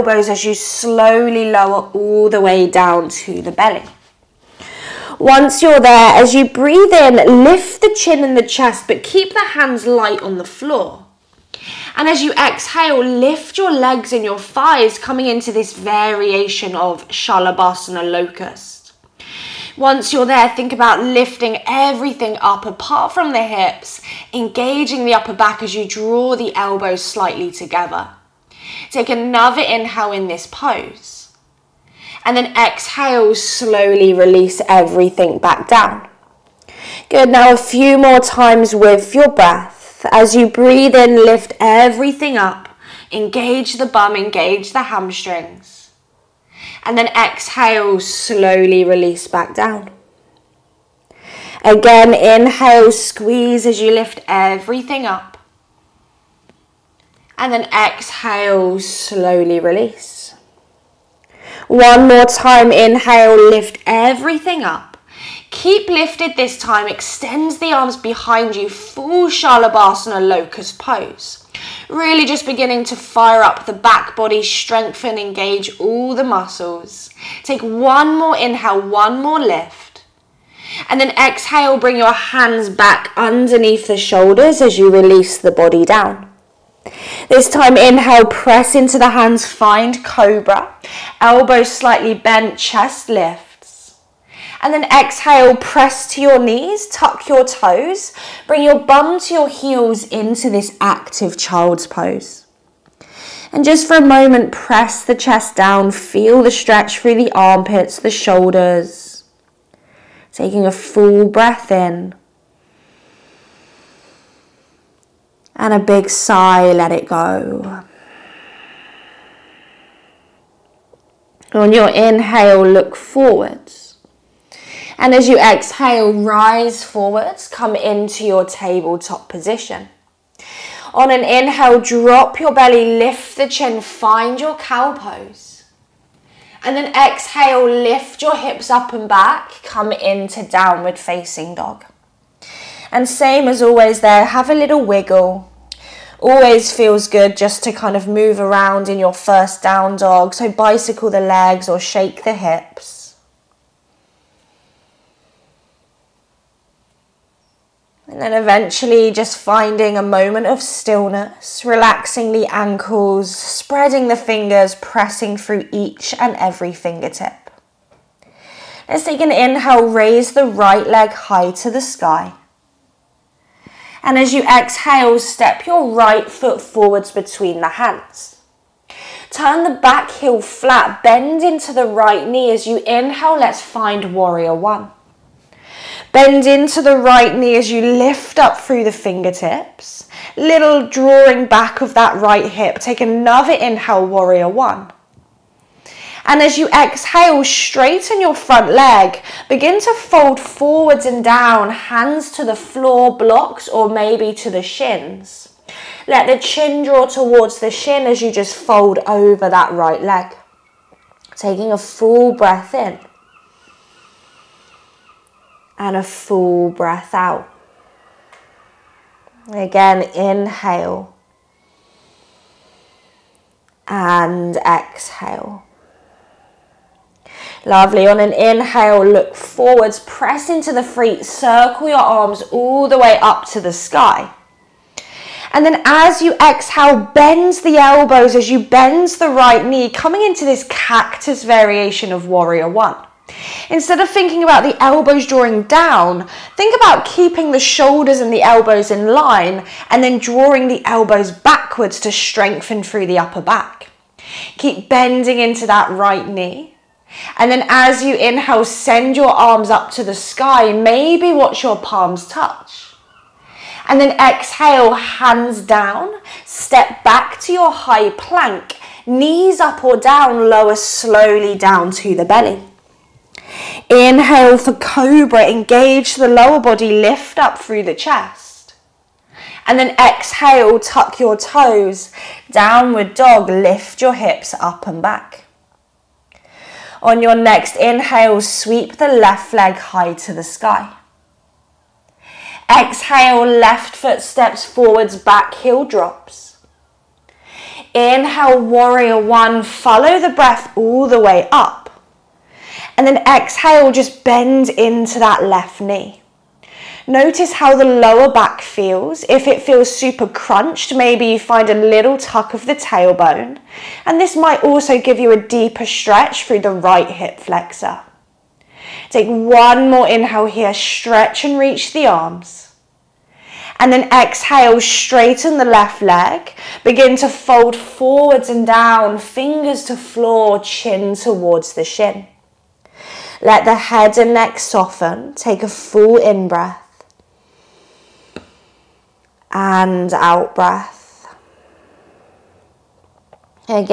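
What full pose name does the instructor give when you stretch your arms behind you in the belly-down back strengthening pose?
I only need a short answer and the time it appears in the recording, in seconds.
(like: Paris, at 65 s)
Full Shalabhasana locust pose, at 68 s.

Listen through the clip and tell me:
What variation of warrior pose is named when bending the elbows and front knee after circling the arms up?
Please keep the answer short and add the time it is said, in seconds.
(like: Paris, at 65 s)
Cactus variation, at 240 s.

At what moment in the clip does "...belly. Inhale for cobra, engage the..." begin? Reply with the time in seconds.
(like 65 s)
272 s.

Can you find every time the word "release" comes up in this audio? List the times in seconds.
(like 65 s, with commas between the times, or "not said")
34 s, 48 s, 59 s, 84 s.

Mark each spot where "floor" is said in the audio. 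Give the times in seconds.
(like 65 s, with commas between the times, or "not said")
10 s, 202 s, 329 s.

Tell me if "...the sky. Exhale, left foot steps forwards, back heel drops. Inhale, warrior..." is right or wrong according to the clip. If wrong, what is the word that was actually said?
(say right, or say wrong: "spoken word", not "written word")
right.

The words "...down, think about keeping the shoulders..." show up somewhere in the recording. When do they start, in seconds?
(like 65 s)
245 s.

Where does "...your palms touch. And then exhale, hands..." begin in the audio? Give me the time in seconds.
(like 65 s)
261 s.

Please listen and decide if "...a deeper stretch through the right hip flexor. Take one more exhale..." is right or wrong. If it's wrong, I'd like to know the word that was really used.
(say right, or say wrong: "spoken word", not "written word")
wrong: "inhale", not "exhale".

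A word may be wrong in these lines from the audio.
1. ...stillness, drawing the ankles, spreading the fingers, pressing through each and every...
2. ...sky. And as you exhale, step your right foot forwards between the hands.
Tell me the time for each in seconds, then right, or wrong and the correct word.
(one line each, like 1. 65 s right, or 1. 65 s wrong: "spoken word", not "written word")
1. 160 s wrong: "relaxing", not "drawing"
2. 171 s right.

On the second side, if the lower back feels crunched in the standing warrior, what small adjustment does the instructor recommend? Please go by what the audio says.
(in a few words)
Tuck of the tailbone.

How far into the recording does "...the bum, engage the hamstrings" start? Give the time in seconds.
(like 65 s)
43 s.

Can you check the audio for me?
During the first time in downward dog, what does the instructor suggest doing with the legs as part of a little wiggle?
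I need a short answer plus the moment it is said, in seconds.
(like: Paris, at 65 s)
Bicycle the legs, at 150 s.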